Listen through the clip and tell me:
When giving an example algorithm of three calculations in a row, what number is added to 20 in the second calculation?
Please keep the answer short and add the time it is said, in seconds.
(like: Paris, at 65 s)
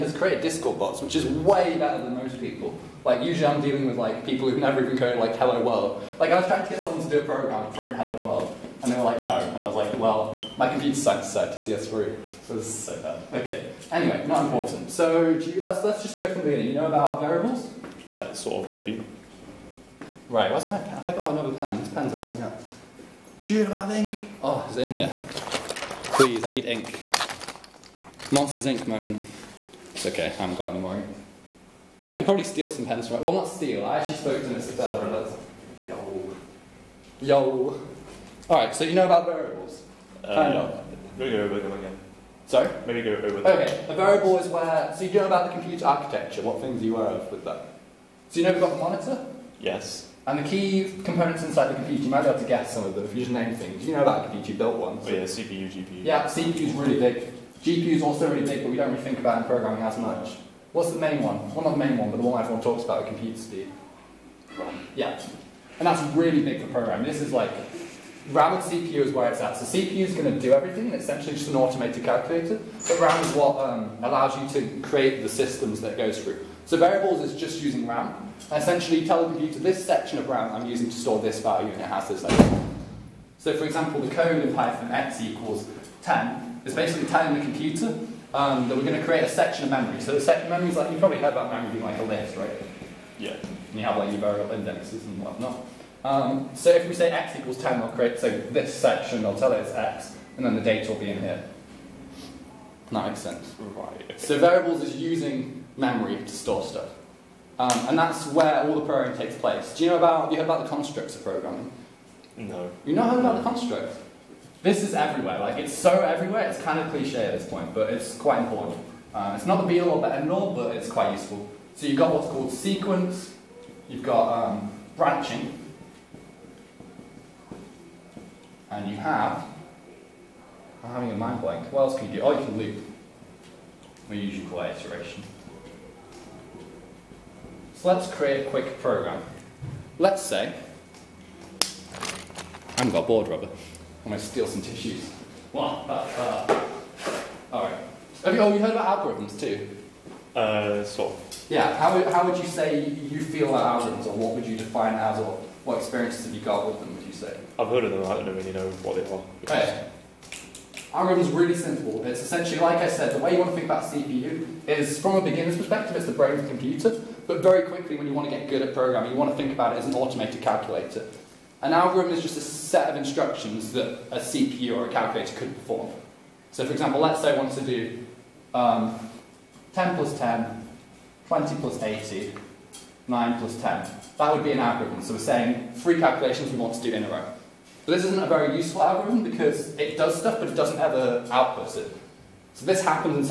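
80, at 181 s.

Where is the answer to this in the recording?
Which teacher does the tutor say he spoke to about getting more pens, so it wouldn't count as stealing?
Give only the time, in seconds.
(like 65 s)
34 s.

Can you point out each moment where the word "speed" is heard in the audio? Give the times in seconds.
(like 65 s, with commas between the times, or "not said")
63 s.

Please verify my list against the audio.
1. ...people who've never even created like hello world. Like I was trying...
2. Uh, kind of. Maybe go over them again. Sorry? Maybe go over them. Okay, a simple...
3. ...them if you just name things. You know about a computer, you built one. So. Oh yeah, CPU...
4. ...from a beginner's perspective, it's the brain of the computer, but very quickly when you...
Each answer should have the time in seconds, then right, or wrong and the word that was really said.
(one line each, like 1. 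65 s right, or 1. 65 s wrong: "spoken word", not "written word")
1. 4 s wrong: "coded", not "created"
2. 40 s wrong: "variable", not "simple"
3. 52 s right
4. 164 s right.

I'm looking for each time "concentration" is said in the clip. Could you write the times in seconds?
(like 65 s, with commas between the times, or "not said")
not said.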